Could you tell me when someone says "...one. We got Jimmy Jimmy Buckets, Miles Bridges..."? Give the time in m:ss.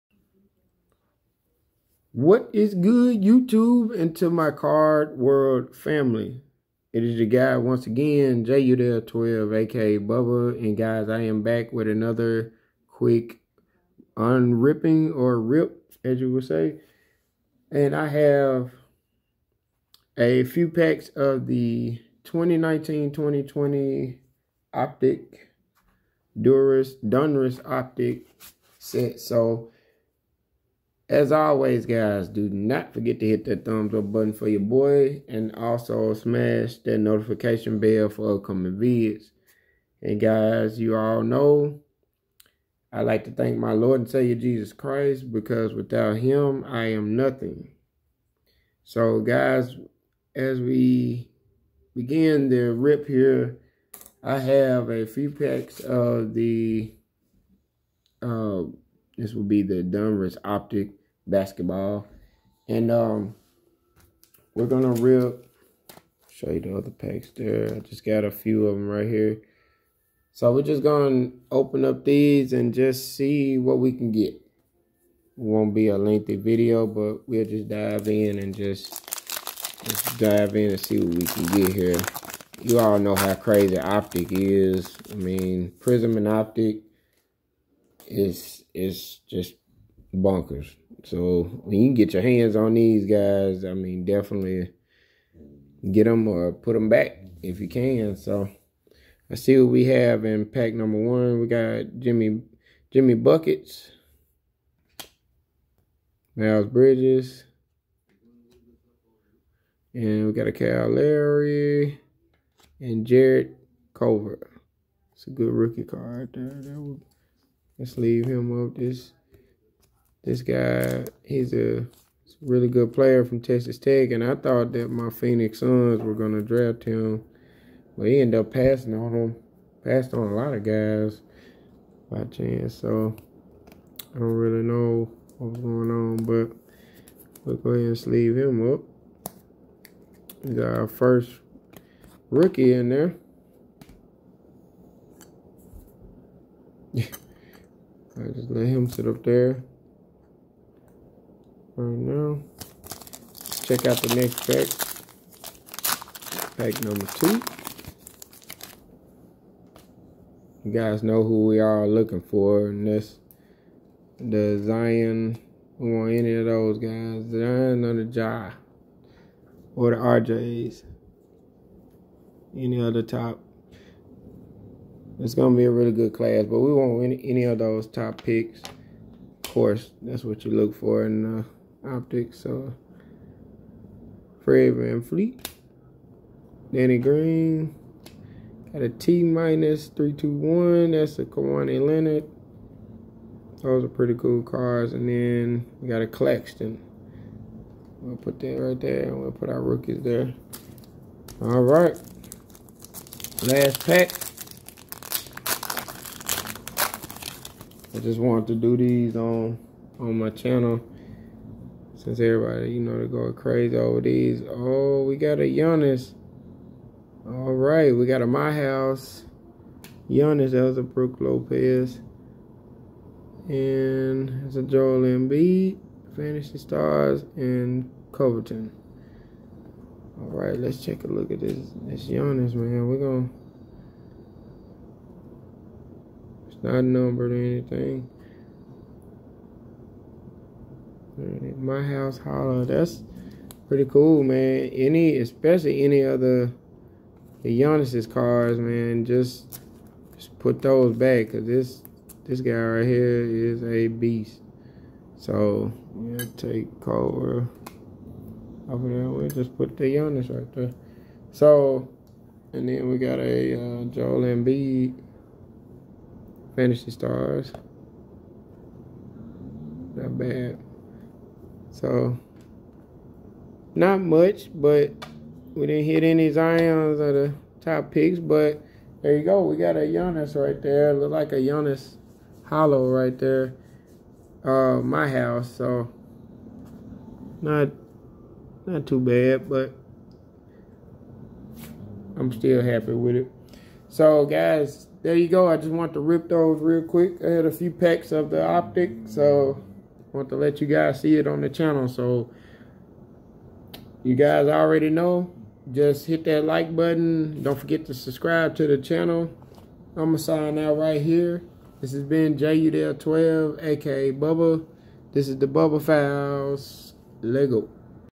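1:40.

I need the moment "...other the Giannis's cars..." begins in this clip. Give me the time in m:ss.
4:06.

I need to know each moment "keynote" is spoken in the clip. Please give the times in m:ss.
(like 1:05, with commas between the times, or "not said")
not said.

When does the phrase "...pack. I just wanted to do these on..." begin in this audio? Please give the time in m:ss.
3:23.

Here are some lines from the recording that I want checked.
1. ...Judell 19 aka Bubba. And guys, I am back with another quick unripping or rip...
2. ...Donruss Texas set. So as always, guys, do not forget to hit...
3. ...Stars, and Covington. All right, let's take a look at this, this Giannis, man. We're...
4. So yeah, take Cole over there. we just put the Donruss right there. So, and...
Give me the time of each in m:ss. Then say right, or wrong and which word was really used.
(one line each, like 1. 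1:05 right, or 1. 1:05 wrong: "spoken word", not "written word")
1. 0:08 wrong: "12", not "19"
2. 0:26 wrong: "Optic", not "Texas"
3. 3:46 right
4. 4:15 wrong: "Giannis", not "Donruss".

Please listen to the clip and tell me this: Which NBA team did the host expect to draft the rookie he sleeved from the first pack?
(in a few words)
Phoenix Suns.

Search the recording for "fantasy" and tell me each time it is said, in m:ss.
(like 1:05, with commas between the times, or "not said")
3:46, 4:26.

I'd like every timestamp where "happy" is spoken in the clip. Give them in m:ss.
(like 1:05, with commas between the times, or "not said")
4:52.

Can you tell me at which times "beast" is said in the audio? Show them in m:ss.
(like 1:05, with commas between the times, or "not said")
4:13.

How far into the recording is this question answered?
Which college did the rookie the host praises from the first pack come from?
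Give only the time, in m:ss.
2:03.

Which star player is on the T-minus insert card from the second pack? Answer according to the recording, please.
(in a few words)
Kawhi Leonard.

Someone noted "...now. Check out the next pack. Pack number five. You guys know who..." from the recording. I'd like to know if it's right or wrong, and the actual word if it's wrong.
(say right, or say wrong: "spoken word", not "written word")
wrong: "two", not "five".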